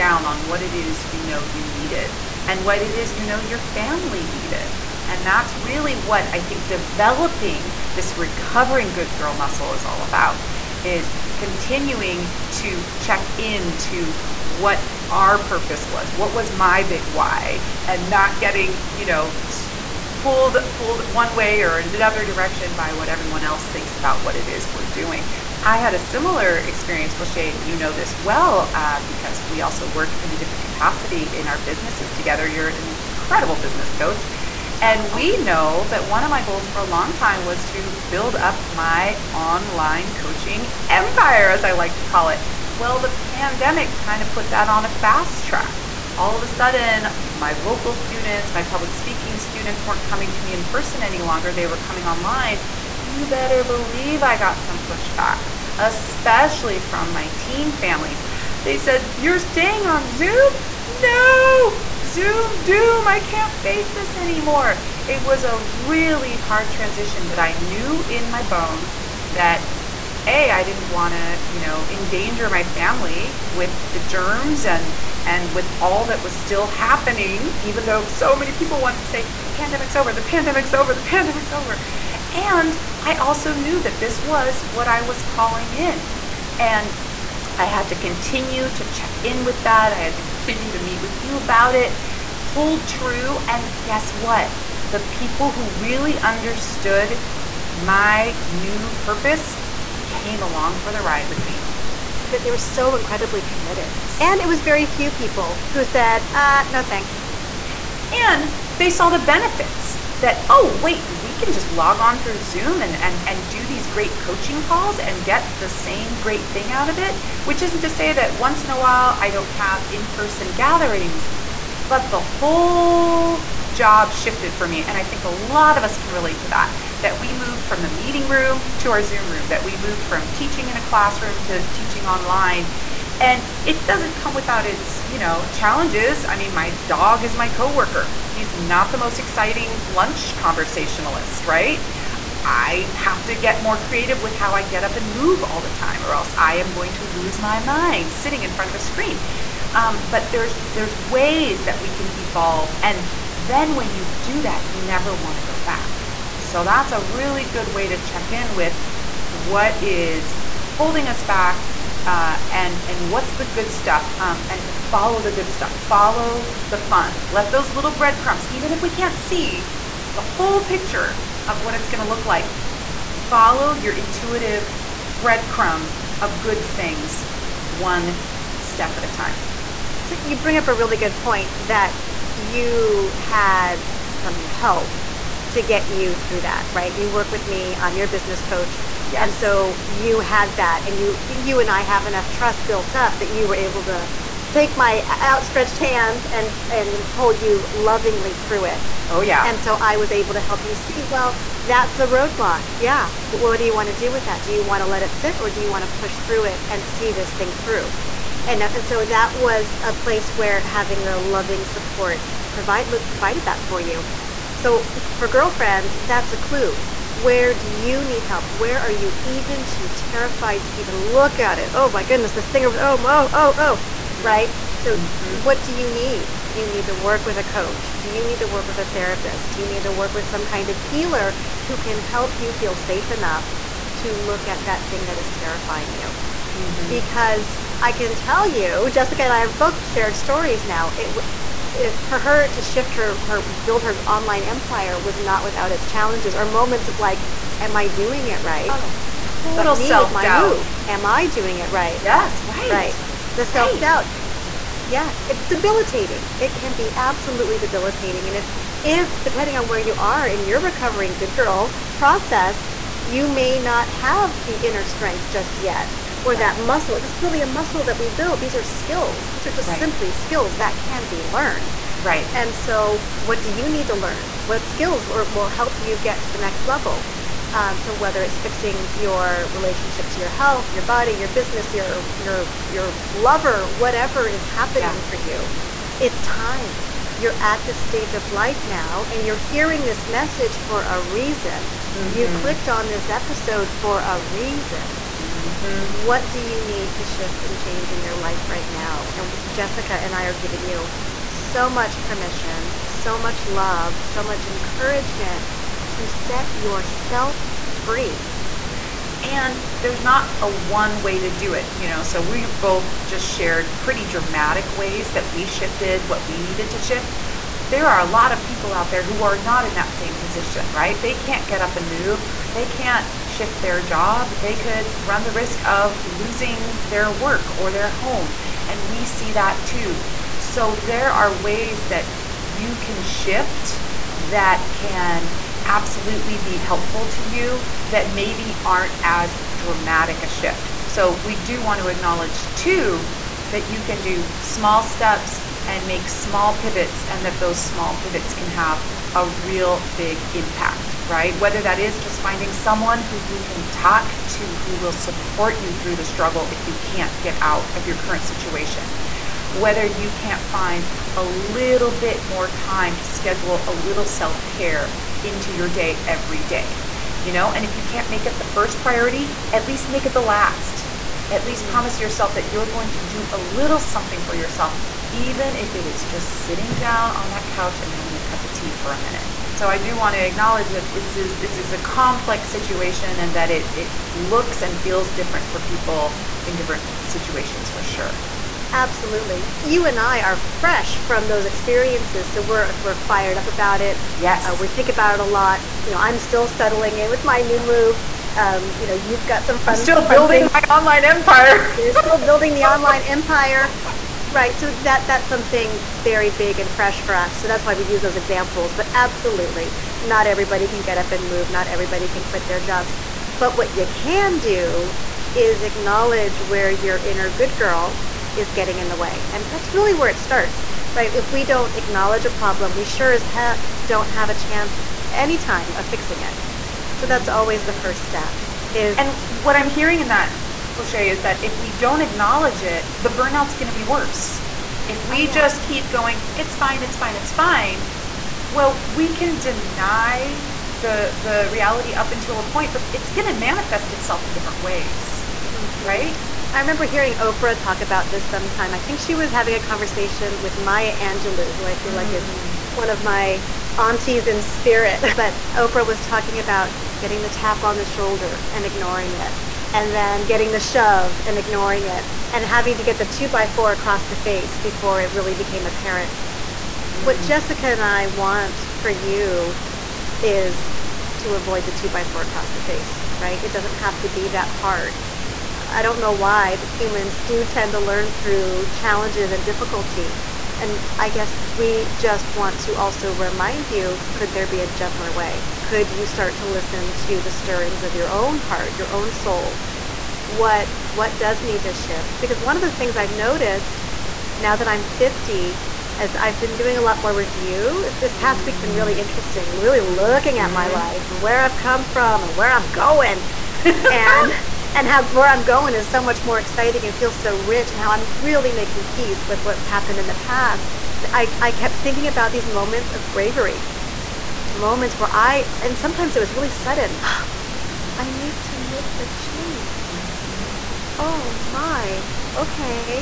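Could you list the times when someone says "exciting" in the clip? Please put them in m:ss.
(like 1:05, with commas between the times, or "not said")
2:19, 8:26.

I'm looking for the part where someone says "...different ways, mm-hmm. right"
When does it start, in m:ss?
7:24.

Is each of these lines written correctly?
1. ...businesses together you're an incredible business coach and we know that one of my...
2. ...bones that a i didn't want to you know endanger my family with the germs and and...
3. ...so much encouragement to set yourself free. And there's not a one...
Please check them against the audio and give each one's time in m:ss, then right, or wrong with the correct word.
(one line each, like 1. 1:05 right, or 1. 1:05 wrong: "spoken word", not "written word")
1. 0:31 right
2. 1:08 right
3. 5:04 right.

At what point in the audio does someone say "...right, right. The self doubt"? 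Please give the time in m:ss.
4:12.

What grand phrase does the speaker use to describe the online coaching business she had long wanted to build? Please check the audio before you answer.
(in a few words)
online coaching empire.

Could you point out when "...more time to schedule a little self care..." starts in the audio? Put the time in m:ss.
6:02.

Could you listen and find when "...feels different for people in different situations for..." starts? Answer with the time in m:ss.
6:24.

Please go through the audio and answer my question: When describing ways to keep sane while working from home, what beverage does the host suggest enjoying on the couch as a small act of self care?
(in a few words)
tea.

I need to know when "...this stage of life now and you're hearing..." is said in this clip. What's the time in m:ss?
4:47.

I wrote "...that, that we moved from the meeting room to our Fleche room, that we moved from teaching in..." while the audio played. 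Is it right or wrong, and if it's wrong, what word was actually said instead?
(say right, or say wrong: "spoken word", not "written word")
wrong: "Zoom", not "Fleche".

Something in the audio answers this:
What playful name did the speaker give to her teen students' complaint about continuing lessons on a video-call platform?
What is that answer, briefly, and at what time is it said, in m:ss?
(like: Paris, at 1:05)
Zoom doom, at 1:02.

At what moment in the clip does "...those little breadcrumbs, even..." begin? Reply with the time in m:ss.
2:47.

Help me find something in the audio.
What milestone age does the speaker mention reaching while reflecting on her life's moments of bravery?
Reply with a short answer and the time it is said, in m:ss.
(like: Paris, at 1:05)
50, at 8:14.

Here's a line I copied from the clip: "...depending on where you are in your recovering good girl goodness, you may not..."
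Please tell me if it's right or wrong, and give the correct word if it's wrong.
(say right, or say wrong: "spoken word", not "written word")
wrong: "process", not "goodness".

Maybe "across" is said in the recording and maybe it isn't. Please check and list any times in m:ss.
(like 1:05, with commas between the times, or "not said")
7:43, 7:52.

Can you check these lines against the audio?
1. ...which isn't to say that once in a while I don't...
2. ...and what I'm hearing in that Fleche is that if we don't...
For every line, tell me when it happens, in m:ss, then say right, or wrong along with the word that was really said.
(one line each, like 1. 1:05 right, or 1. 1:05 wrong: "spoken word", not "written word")
1. 1:57 right
2. 7:08 right.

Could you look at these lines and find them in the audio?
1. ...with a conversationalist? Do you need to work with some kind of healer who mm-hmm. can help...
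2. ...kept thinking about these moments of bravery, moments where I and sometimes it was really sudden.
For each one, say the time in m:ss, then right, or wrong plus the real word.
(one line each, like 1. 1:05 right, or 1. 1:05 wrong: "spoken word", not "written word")
1. 3:48 wrong: "therapist", not "conversationalist"
2. 8:31 right.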